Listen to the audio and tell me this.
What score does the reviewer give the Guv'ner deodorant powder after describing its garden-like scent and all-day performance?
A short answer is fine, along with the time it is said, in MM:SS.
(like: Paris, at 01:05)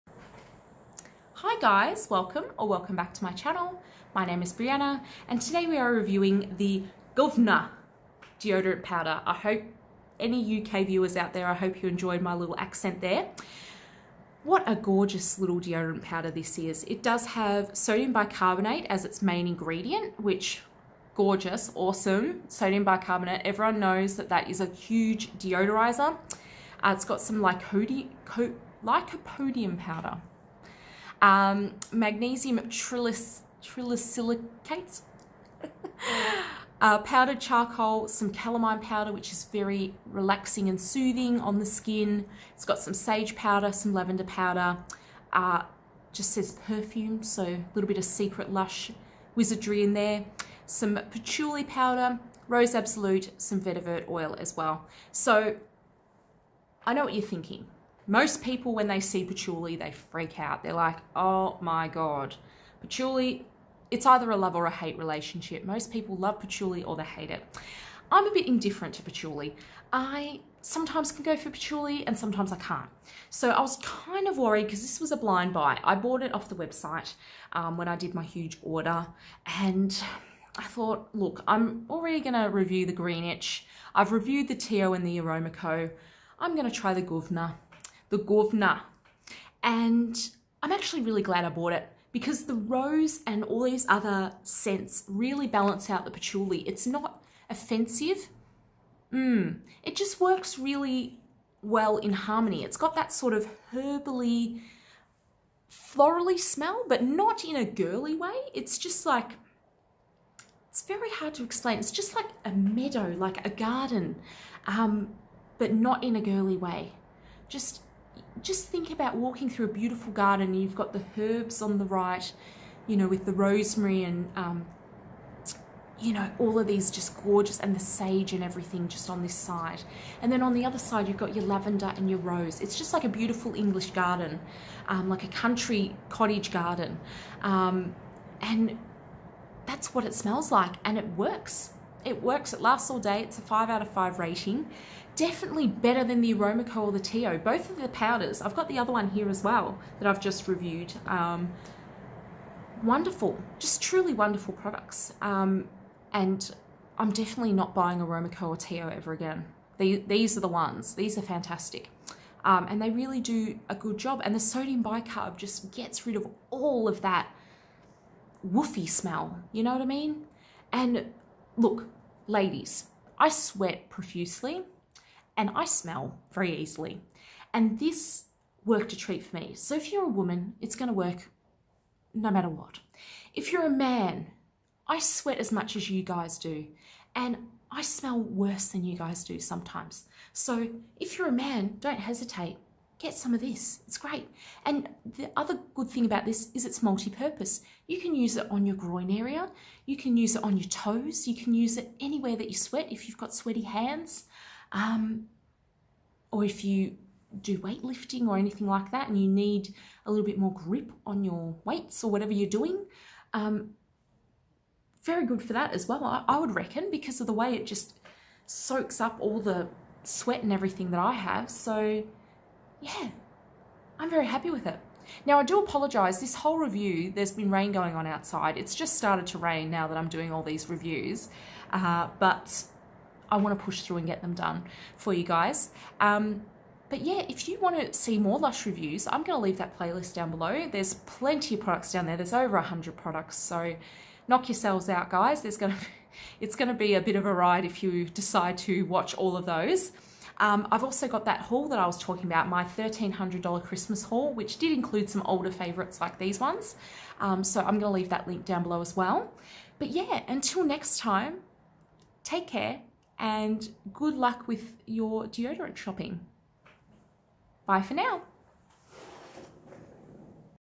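5 out of 5, at 02:23.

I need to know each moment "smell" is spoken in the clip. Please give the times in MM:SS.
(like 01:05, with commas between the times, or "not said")
01:46, 02:20, 02:48, 02:55, 03:07.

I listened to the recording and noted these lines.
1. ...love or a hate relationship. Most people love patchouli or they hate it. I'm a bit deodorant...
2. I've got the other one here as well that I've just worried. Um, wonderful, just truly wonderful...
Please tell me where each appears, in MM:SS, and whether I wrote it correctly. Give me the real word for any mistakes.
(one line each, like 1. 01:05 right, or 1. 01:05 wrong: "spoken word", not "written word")
1. 01:04 wrong: "indifferent", not "deodorant"
2. 02:28 wrong: "reviewed", not "worried".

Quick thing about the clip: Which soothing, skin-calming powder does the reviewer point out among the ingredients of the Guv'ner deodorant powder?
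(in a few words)
calamine powder.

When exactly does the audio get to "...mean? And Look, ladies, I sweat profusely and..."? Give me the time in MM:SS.
02:49.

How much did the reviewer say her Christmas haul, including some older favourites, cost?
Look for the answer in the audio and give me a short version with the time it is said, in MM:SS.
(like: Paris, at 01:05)
$1,300, at 04:12.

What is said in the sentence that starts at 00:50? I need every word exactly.
Some patchouli powder, rose absolute, some vetiver oil as well.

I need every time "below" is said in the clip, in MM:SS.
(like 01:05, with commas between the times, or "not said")
04:00, 04:18.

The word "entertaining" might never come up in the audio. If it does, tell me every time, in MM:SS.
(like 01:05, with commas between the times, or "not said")
not said.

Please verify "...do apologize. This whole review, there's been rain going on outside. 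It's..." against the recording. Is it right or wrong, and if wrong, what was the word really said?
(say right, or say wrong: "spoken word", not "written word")
right.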